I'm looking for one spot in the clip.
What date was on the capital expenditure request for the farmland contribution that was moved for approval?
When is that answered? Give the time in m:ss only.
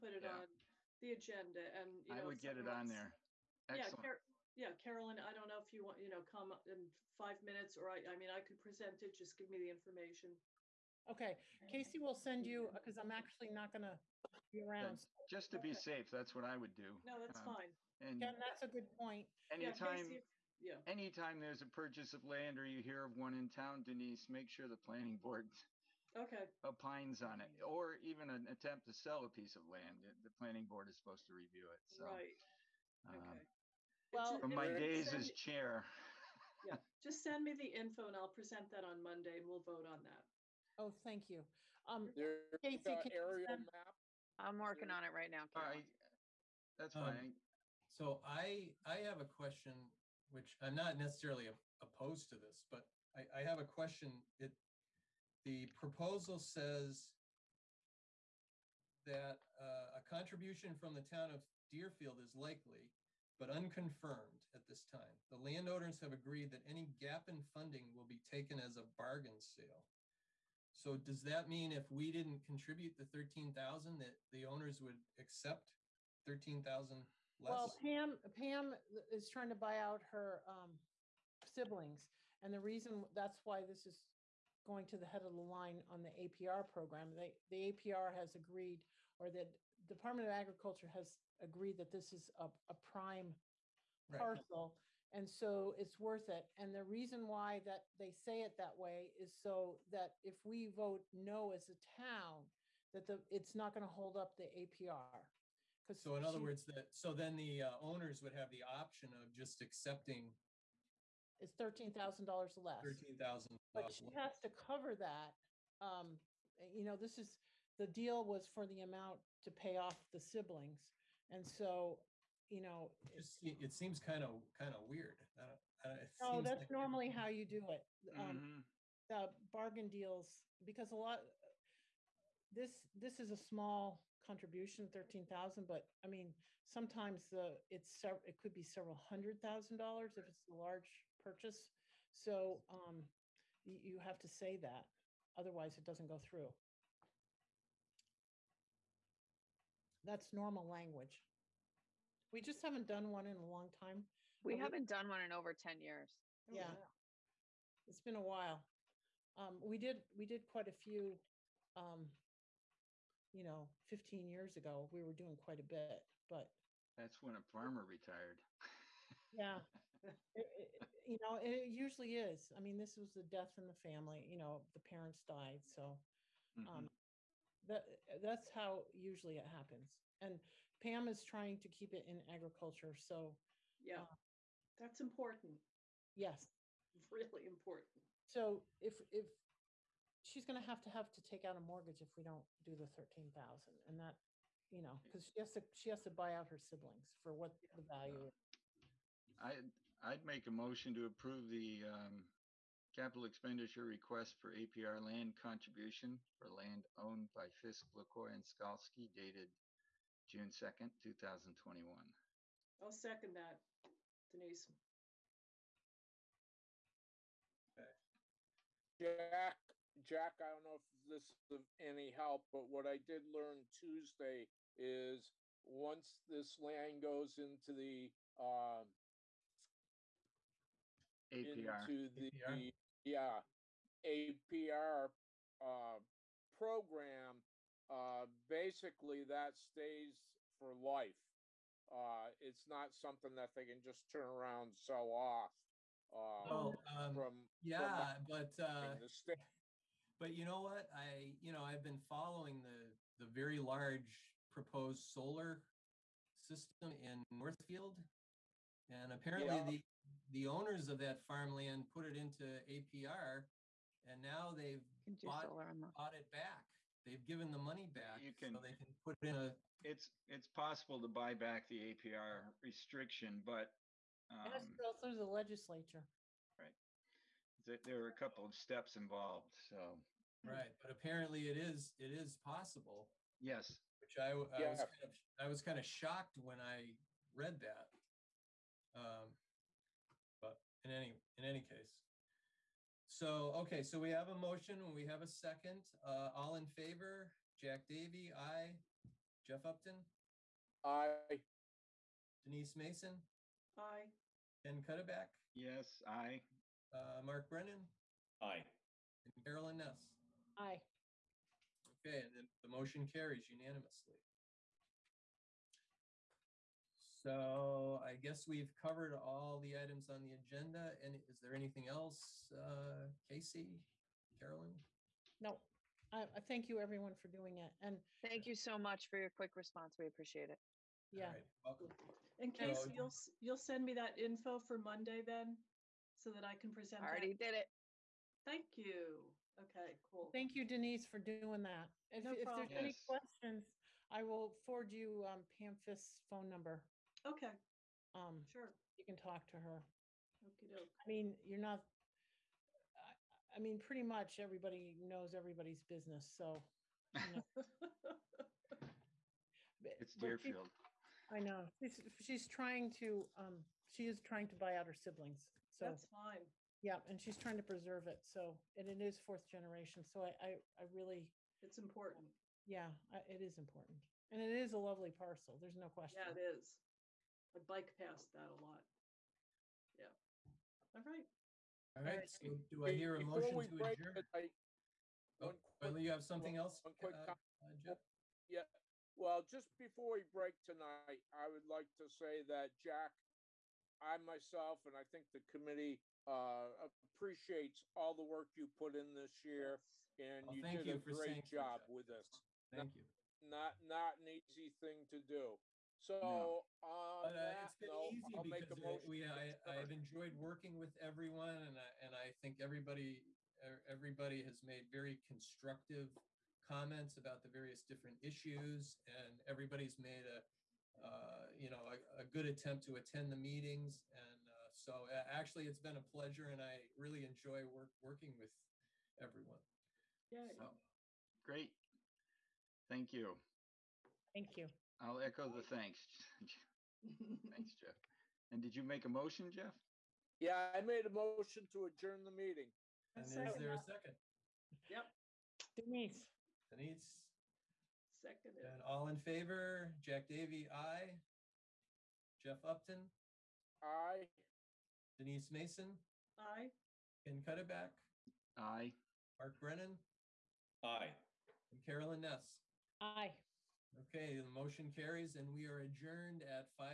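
3:30.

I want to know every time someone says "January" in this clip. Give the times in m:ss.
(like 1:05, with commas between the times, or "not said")
not said.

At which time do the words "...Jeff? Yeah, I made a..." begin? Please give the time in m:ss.
7:19.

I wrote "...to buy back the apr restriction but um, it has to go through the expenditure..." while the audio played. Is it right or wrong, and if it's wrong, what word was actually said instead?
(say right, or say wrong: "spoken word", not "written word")
wrong: "legislature", not "expenditure".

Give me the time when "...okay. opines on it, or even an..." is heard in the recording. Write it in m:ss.
0:26.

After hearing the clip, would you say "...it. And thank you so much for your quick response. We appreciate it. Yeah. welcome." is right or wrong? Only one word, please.
right.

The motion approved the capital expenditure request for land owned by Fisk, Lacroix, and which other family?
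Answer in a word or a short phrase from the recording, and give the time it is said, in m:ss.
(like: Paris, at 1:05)
Skalski, at 3:28.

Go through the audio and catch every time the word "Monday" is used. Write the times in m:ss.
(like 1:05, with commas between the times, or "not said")
0:39, 5:34.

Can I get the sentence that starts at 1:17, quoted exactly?
Well, Pam, Pam is trying to buy out her um, siblings.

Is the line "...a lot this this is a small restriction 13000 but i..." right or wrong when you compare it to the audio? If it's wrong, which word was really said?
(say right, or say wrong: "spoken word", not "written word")
wrong: "contribution", not "restriction".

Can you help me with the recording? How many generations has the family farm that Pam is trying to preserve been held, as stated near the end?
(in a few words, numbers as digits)
fourth generation.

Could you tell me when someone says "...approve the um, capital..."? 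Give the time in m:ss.
3:21.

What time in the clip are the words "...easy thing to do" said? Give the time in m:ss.
6:44.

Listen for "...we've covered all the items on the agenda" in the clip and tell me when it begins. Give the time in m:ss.
5:18.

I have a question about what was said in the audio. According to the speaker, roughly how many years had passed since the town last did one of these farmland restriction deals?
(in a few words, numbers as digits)
10 years.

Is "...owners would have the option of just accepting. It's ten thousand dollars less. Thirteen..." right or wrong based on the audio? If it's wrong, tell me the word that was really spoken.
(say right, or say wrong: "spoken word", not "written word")
wrong: "thirteen", not "ten".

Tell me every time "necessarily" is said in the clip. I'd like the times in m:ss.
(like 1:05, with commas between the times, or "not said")
0:50.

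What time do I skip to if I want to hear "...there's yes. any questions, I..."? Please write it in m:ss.
5:42.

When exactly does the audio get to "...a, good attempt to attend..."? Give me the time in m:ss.
7:02.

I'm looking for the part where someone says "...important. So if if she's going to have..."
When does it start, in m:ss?
3:07.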